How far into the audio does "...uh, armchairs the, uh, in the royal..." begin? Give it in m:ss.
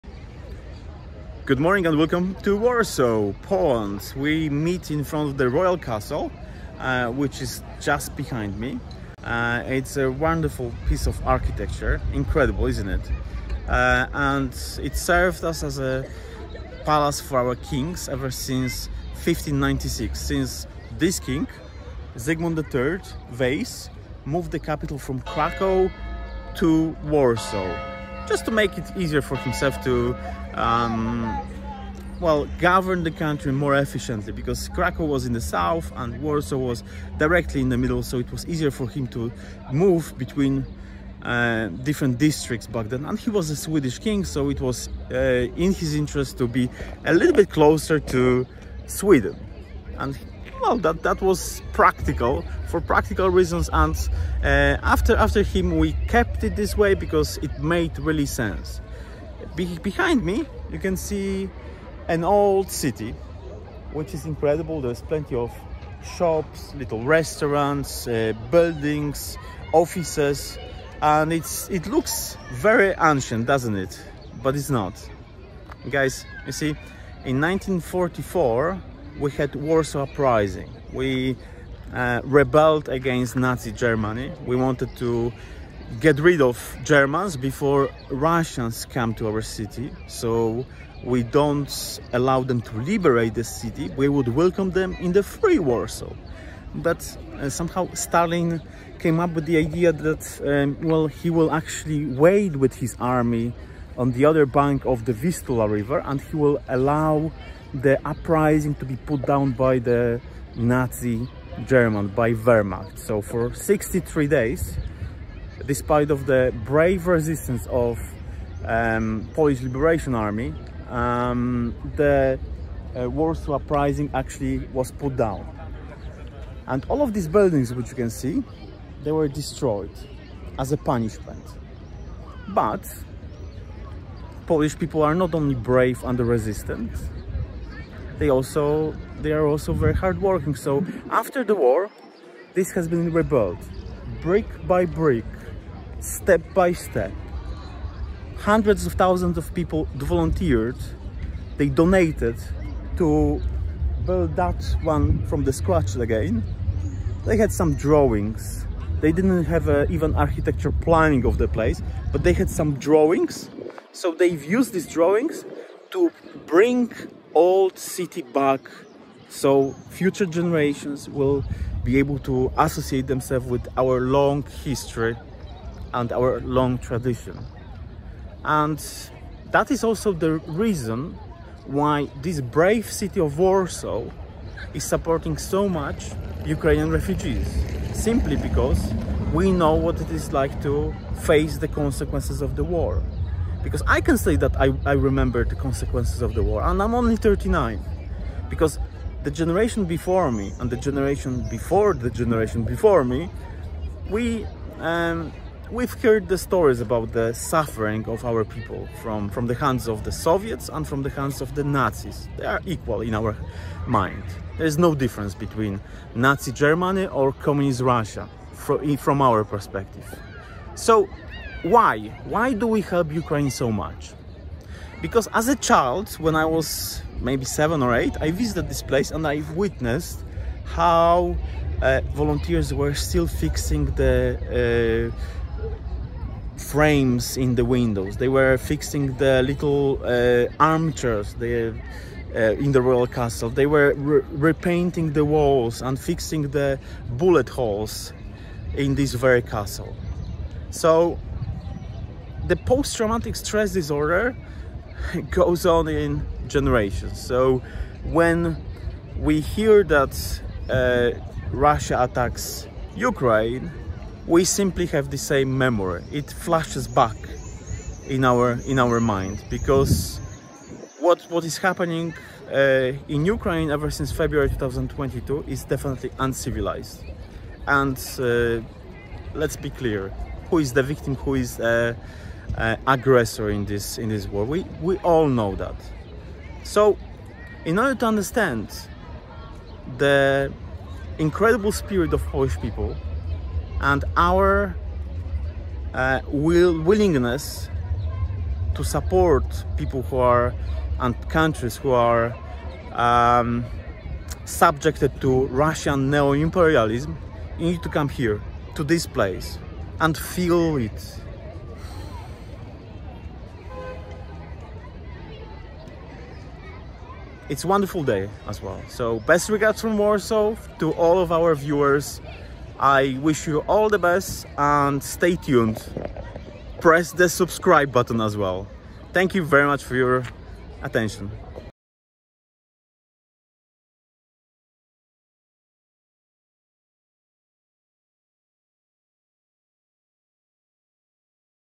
4:00.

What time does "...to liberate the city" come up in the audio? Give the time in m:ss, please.
1:32.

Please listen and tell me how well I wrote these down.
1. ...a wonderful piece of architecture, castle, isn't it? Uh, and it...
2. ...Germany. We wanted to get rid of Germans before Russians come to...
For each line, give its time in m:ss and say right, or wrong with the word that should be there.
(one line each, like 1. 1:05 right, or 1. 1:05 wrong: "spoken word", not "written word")
1. 0:09 wrong: "incredible", not "castle"
2. 1:23 right.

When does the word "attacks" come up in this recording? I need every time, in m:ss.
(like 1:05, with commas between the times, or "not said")
4:22.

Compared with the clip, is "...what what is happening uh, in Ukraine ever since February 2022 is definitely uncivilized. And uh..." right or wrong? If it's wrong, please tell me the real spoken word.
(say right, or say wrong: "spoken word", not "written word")
right.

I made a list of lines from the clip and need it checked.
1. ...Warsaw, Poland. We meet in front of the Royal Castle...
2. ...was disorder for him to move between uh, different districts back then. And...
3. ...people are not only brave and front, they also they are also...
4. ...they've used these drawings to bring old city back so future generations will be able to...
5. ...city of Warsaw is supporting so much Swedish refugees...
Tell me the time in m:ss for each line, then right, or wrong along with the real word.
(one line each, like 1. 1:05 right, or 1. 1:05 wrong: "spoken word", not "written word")
1. 0:02 right
2. 0:38 wrong: "easier", not "disorder"
3. 2:14 wrong: "resistant", not "front"
4. 2:44 right
5. 3:02 wrong: "Ukrainian", not "Swedish".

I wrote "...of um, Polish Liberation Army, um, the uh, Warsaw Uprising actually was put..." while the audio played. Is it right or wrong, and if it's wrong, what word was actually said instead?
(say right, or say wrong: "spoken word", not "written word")
right.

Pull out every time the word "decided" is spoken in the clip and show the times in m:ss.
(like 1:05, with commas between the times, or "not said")
not said.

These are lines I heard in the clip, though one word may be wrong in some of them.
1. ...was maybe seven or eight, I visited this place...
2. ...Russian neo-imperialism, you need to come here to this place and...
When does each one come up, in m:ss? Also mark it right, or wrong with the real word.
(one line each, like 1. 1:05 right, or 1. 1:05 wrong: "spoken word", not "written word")
1. 3:46 right
2. 5:05 right.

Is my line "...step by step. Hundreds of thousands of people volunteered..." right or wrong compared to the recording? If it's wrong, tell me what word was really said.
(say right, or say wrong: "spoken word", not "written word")
right.